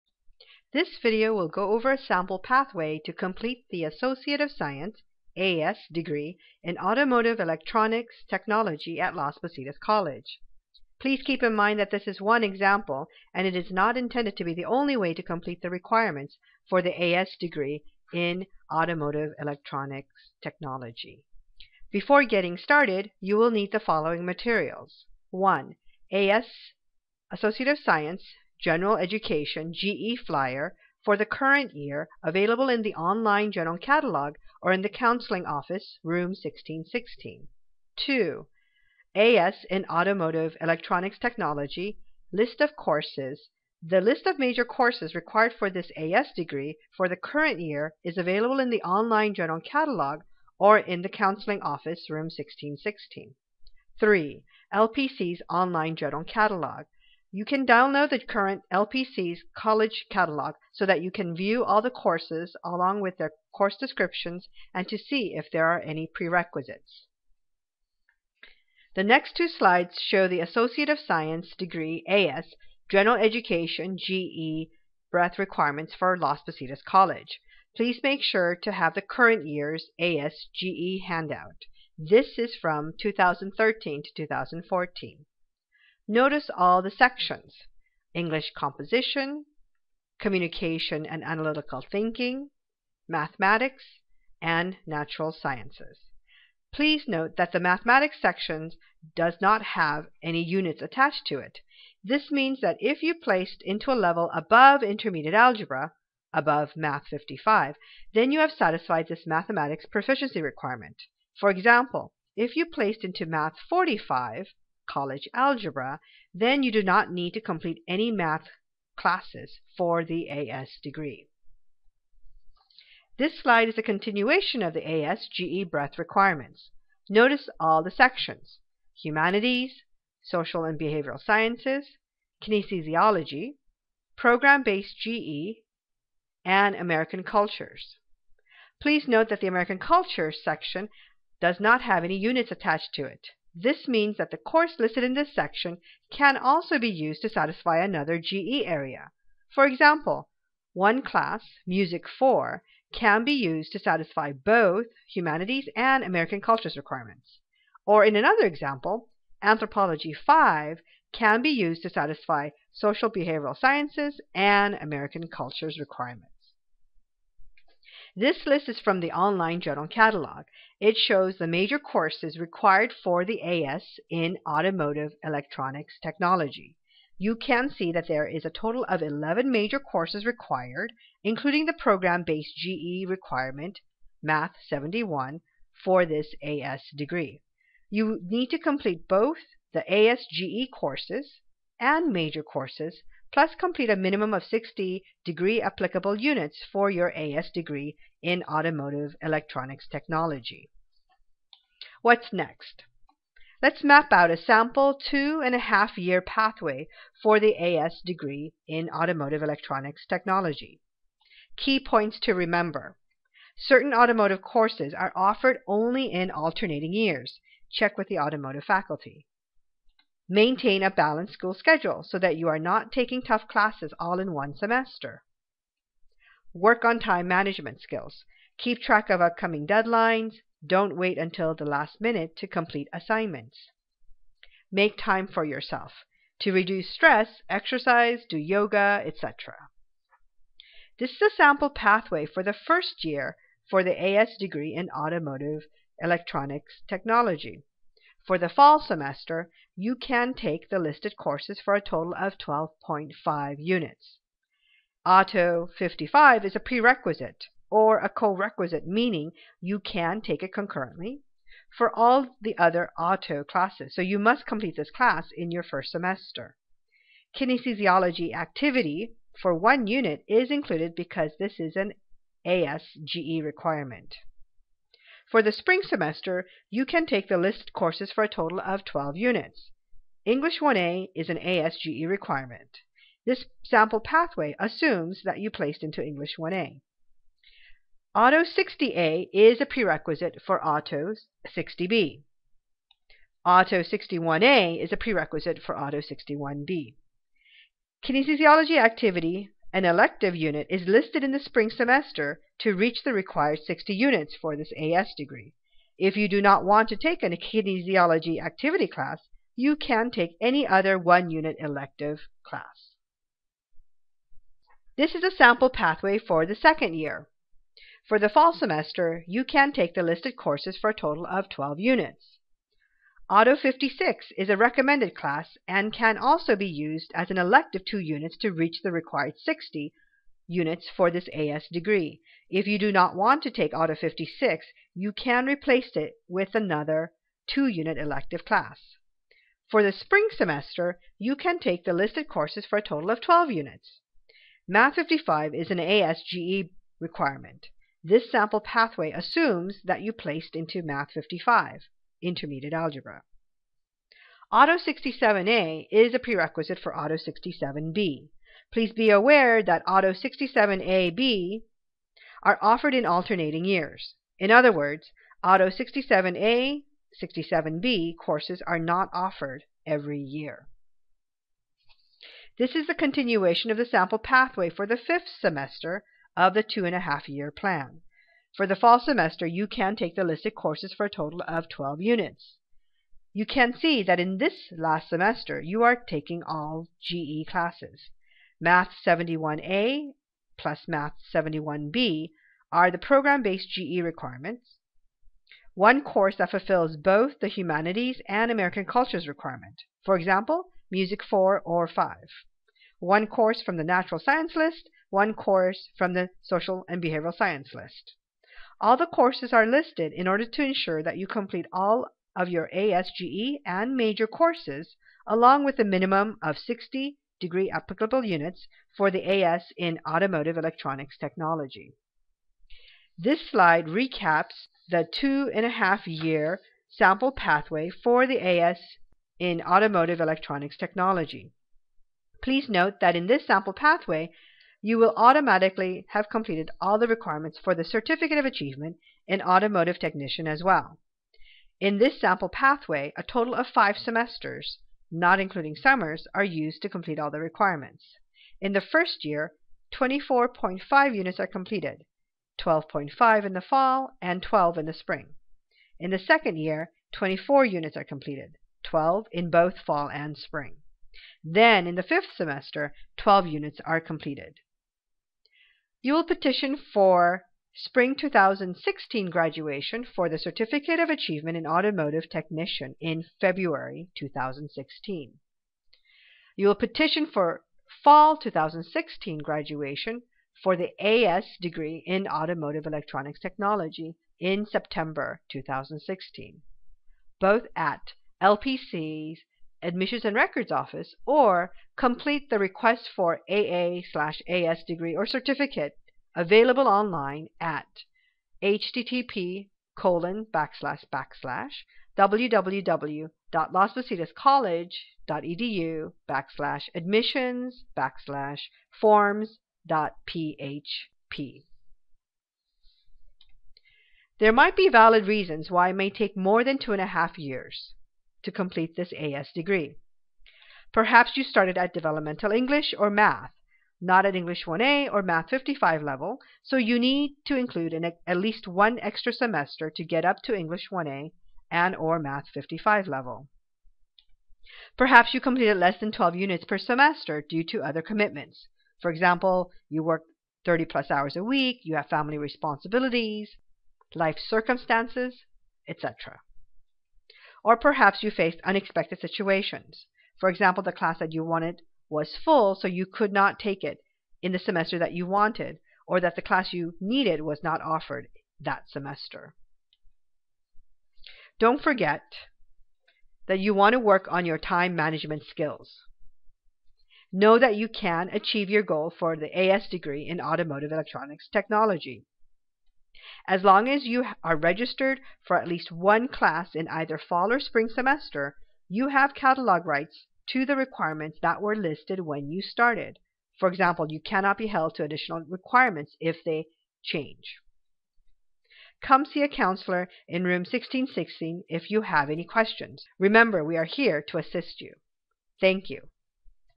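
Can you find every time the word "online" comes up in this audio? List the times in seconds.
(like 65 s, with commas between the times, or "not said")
32 s, 48 s, 55 s, 169 s.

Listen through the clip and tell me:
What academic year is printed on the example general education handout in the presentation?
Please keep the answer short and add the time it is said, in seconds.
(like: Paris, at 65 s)
2013 to 2014, at 82 s.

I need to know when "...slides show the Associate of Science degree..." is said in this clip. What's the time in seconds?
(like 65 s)
69 s.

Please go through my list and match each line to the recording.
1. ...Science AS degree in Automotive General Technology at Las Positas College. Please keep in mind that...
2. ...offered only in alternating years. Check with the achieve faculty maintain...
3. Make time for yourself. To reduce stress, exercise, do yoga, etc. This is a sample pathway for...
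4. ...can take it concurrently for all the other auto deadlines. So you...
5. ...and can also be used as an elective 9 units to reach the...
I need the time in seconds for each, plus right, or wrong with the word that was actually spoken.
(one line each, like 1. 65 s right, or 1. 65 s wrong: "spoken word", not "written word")
1. 4 s wrong: "Electronics", not "General"
2. 215 s wrong: "automotive", not "achieve"
3. 234 s right
4. 259 s wrong: "classes", not "deadlines"
5. 325 s wrong: "2", not "9".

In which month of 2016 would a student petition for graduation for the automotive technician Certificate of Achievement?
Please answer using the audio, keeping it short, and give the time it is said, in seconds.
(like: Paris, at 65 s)
February, at 473 s.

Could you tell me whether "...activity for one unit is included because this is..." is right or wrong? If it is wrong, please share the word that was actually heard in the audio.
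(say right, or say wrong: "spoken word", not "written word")
right.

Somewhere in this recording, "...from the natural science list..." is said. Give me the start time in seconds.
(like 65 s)
403 s.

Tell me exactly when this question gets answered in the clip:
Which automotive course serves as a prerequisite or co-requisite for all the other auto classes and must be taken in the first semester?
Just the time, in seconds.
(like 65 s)
255 s.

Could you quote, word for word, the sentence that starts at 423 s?
This slide recaps the two and a half year sample pathway for the AS in Automotive Electronics Technology.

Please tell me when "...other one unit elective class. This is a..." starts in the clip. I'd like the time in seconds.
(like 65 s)
310 s.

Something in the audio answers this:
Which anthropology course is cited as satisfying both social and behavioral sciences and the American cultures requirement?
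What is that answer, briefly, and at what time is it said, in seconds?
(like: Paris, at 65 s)
Anthropology 5, at 159 s.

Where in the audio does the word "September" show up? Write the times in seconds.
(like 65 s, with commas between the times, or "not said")
484 s.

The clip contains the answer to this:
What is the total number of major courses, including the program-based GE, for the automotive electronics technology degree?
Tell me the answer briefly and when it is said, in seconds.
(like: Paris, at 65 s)
11, at 179 s.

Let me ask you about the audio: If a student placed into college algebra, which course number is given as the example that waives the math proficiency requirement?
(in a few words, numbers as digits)
Math 45.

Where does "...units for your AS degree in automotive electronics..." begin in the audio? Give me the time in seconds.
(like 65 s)
196 s.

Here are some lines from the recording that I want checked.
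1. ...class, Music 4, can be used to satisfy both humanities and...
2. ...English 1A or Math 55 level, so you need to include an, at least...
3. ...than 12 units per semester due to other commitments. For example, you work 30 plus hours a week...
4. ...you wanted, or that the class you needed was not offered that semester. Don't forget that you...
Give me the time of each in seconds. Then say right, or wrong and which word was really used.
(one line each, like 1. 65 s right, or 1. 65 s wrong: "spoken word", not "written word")
1. 151 s right
2. 524 s right
3. 535 s right
4. 555 s right.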